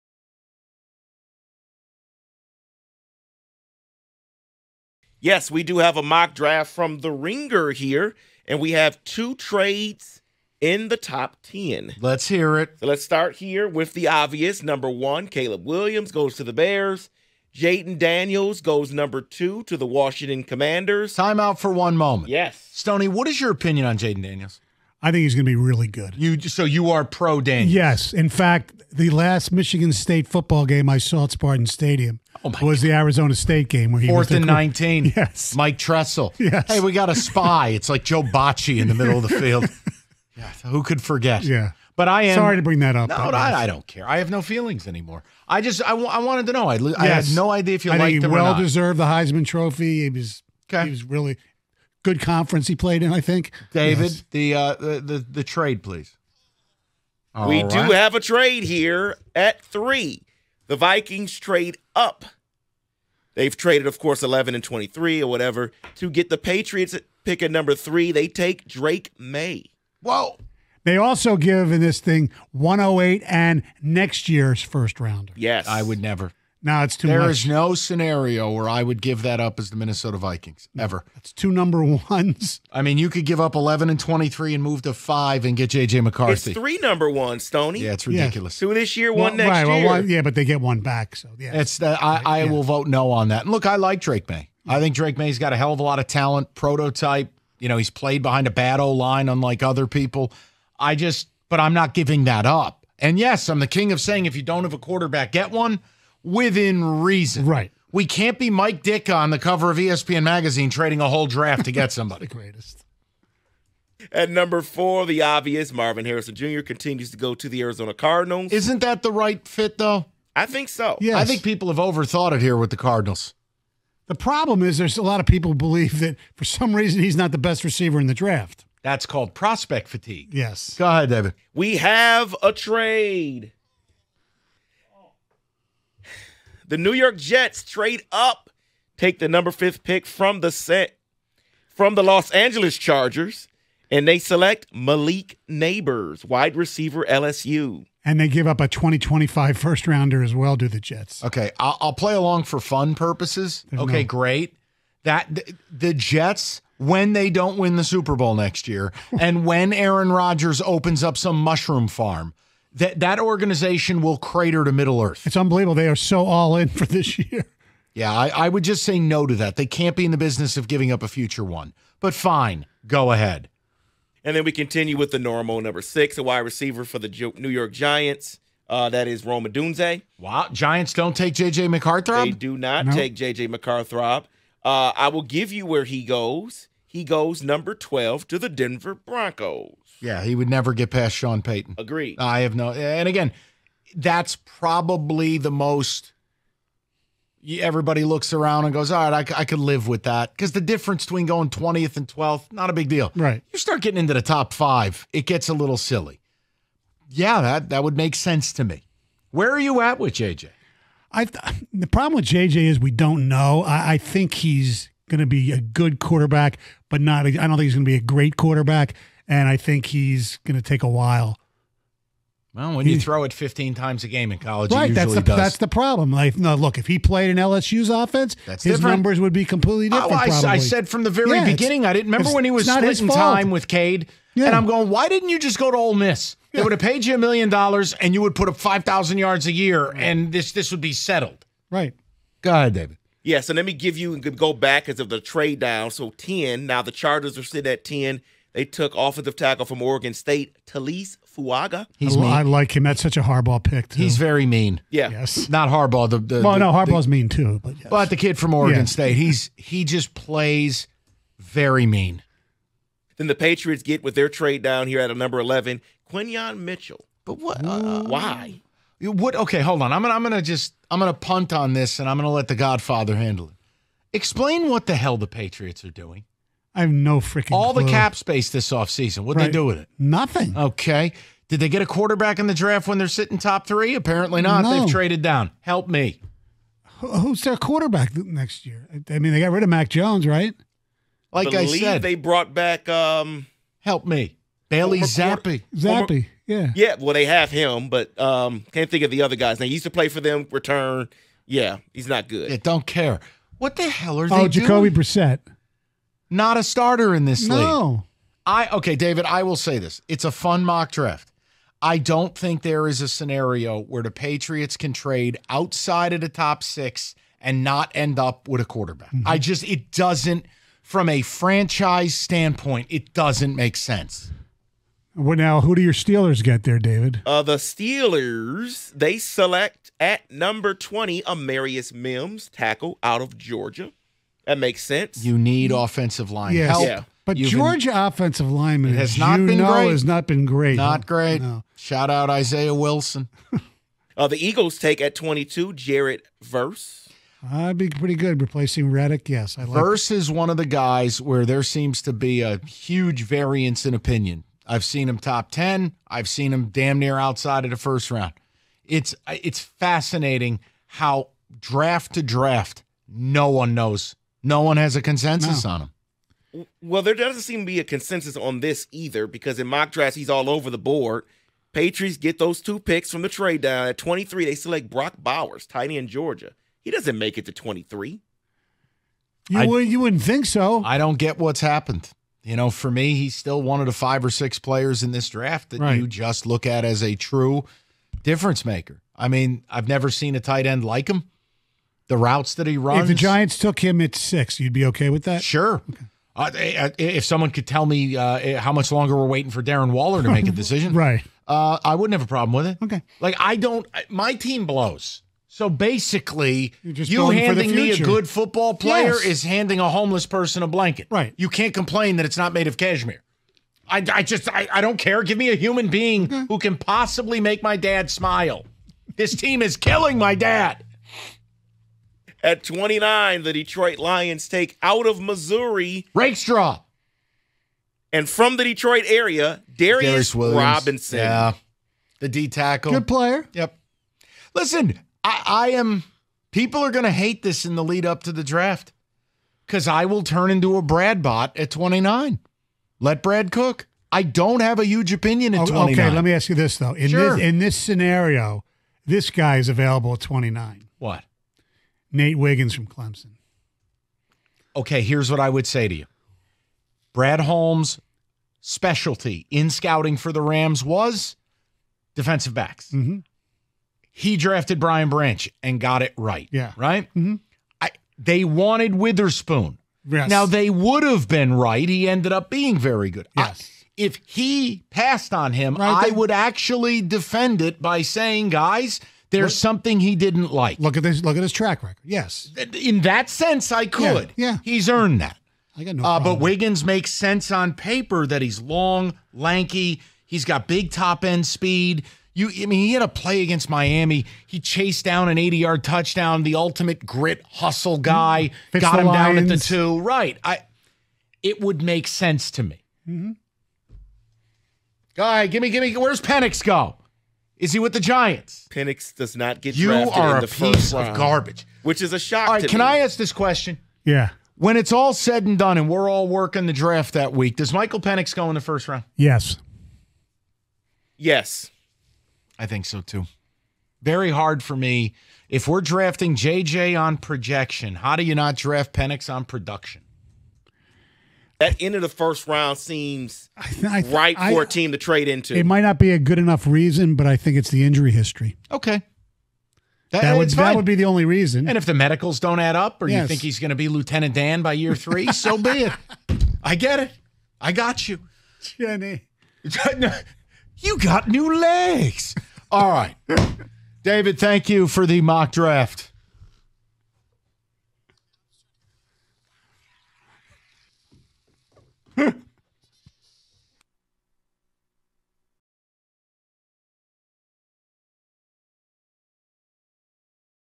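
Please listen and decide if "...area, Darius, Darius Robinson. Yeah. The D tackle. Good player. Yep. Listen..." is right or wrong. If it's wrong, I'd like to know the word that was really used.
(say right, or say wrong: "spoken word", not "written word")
right.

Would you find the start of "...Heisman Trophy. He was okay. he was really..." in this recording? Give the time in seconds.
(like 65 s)
49 s.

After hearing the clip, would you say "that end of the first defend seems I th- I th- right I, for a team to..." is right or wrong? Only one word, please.
wrong.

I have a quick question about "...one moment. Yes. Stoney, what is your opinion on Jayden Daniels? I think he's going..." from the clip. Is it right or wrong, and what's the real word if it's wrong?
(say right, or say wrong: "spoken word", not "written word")
right.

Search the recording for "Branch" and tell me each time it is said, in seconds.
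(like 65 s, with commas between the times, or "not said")
465 s.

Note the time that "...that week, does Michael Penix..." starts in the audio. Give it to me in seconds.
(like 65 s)
517 s.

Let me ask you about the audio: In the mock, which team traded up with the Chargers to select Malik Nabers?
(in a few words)
New York Jets.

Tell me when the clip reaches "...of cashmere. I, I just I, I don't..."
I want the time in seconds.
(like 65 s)
412 s.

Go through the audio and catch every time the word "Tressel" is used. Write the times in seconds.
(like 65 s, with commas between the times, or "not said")
35 s.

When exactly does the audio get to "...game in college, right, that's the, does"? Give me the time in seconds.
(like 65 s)
224 s.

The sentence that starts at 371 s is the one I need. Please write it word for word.
Patriots get those two picks from the trade down.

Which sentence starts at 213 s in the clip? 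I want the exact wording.
I, I think he's going to be a good quarterback, but not.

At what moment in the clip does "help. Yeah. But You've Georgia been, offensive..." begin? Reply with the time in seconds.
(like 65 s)
336 s.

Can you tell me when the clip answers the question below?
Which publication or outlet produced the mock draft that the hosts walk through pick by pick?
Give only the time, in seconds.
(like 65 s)
6 s.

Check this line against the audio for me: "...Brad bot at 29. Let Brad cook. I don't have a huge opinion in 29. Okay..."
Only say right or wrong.
right.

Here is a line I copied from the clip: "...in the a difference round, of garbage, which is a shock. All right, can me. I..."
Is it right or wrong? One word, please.
wrong.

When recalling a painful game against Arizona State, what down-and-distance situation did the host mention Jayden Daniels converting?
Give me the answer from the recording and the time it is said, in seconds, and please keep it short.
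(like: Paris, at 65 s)
fourth and nineteen, at 34 s.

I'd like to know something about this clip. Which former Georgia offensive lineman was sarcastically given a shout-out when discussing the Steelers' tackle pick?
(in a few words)
Isaiah Wilson.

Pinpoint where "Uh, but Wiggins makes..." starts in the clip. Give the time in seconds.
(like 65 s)
486 s.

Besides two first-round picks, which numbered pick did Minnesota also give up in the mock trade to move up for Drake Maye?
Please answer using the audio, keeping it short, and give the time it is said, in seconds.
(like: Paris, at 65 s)
108, at 72 s.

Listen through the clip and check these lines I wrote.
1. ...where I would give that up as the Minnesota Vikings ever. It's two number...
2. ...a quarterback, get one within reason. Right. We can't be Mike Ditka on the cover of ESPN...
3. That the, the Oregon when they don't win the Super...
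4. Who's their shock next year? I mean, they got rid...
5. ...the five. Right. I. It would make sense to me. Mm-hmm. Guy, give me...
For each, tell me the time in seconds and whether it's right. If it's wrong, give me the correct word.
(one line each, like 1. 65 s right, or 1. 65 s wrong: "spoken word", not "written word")
1. 78 s right
2. 104 s right
3. 155 s wrong: "Jets", not "Oregon"
4. 286 s wrong: "quarterback", not "shock"
5. 499 s wrong: "two", not "five".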